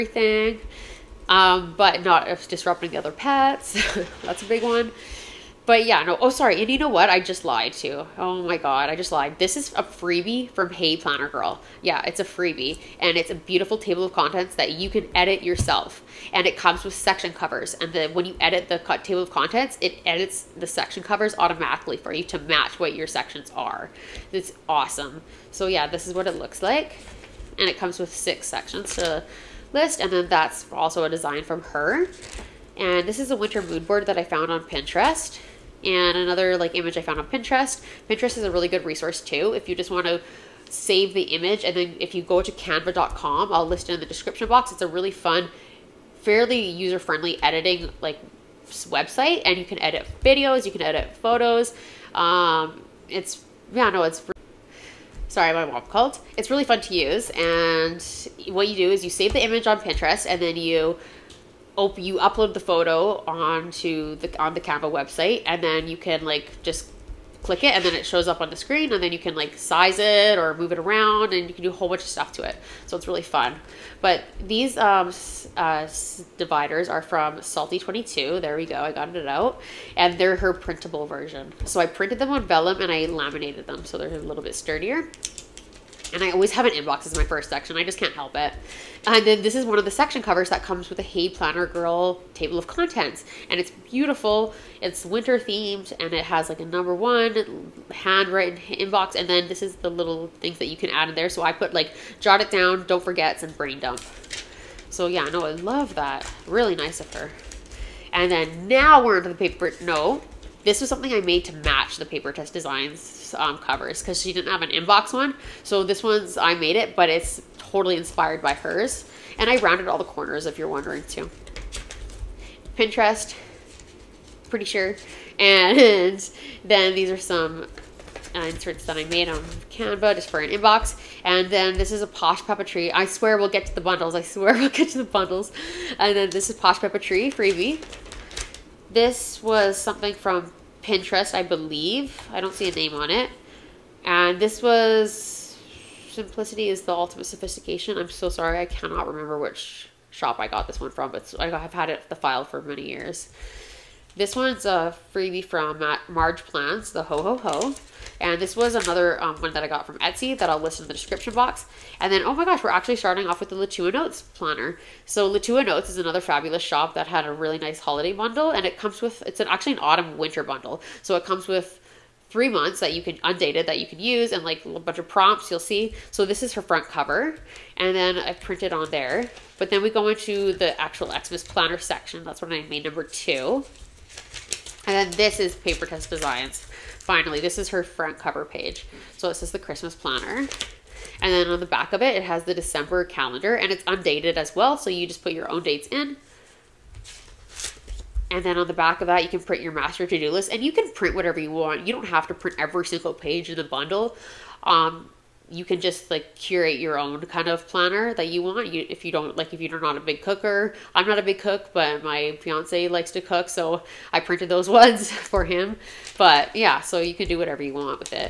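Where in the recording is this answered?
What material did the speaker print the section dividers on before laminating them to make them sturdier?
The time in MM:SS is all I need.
01:22.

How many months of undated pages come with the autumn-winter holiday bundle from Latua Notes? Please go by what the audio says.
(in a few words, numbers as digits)
3.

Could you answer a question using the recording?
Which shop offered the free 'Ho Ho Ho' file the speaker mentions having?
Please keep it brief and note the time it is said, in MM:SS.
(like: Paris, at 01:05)
Marge Plans, at 02:36.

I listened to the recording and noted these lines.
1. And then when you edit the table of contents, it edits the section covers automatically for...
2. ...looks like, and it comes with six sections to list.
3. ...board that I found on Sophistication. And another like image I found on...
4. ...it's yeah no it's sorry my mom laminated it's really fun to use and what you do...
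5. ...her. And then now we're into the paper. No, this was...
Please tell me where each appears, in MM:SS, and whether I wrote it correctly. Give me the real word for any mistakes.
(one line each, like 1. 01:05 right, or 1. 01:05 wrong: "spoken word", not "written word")
1. 00:17 right
2. 00:26 right
3. 00:33 wrong: "Pinterest", not "Sophistication"
4. 00:53 wrong: "called", not "laminated"
5. 01:47 right.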